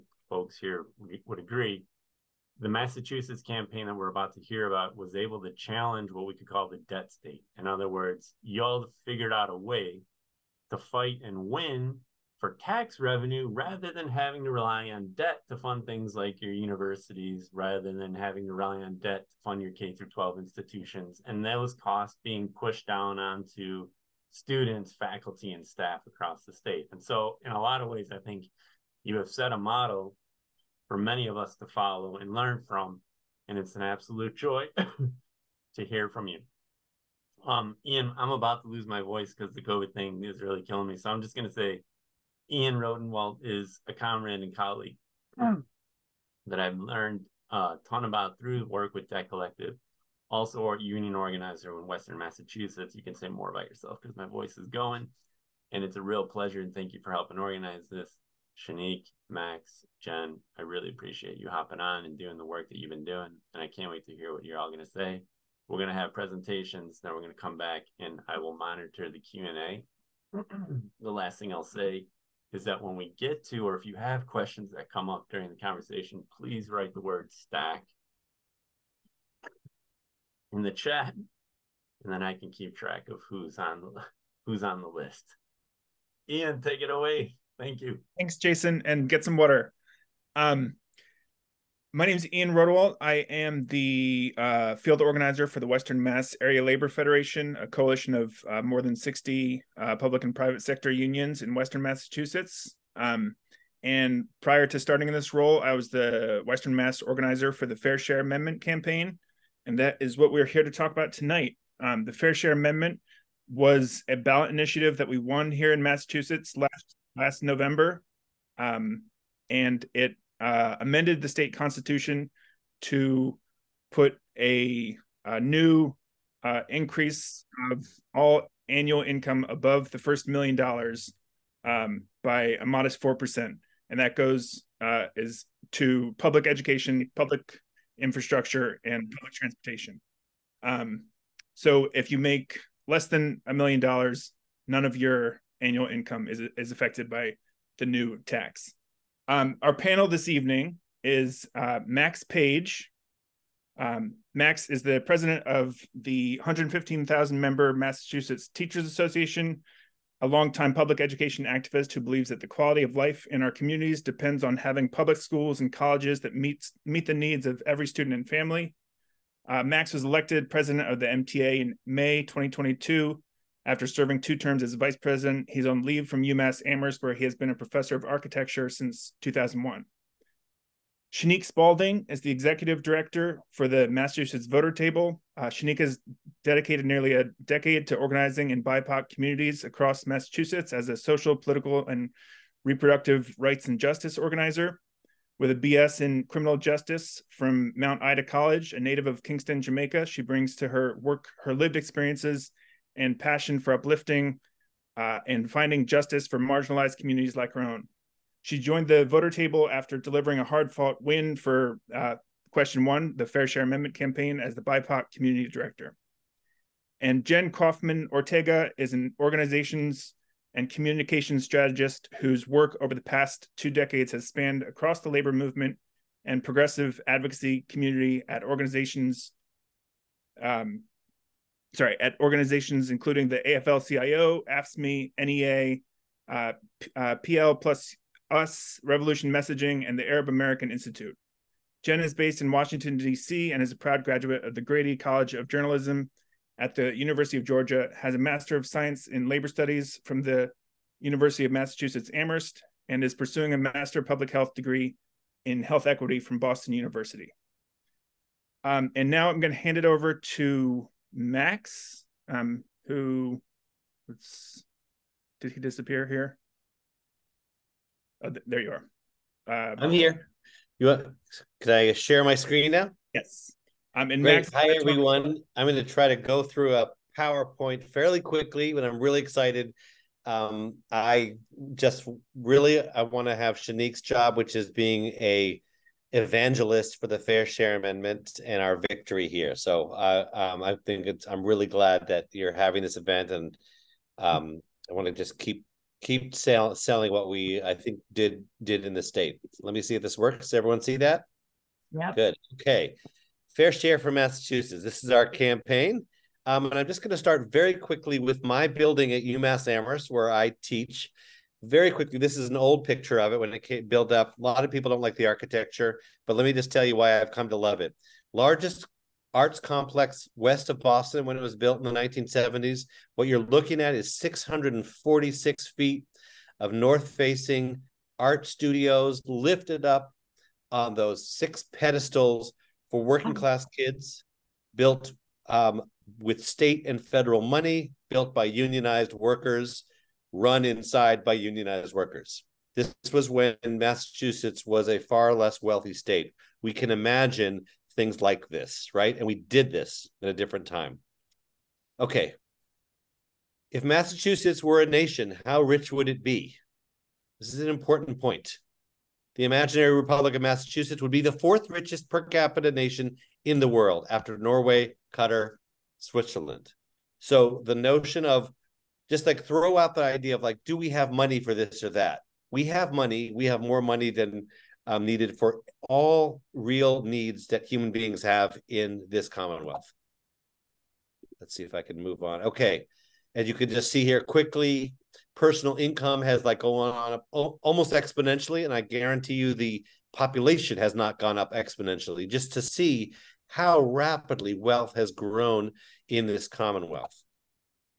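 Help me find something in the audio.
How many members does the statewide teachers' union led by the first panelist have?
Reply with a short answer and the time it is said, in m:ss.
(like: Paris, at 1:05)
115,000, at 2:36.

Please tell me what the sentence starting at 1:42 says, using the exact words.
Um, and prior to starting in this role, I was the Western Mass organizer for the Fair Share Amendment campaign.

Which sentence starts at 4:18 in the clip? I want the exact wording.
Um, and now I'm going to hand it over to Max, um, who let's did he disappear here?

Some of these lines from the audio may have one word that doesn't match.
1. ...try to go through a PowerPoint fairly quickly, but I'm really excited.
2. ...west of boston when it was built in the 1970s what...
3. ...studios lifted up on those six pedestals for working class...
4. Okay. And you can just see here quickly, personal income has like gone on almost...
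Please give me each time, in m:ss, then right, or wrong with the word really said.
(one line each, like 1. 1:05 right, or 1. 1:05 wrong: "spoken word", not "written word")
1. 4:35 right
2. 5:20 right
3. 5:28 right
4. 6:22 right.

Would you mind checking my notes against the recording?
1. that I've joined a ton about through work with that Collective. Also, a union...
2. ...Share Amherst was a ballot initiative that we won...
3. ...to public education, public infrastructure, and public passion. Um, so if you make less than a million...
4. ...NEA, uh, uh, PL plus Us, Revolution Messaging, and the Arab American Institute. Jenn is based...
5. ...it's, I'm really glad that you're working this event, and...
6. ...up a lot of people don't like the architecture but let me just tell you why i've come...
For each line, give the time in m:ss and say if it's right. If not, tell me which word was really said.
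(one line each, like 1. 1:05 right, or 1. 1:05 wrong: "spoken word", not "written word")
1. 0:46 wrong: "learned", not "joined"
2. 1:52 wrong: "Amendment", not "Amherst"
3. 2:15 wrong: "transportation", not "passion"
4. 3:55 right
5. 4:51 wrong: "having", not "working"
6. 5:14 right.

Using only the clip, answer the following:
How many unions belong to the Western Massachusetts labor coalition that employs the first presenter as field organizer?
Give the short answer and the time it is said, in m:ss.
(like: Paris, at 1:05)
more than 60, at 1:38.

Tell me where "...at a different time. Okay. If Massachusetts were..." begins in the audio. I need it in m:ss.
5:50.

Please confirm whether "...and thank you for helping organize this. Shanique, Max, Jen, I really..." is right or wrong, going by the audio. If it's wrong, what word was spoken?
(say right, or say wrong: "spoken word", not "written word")
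right.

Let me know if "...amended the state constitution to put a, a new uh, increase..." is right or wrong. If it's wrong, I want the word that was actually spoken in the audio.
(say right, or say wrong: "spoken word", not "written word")
right.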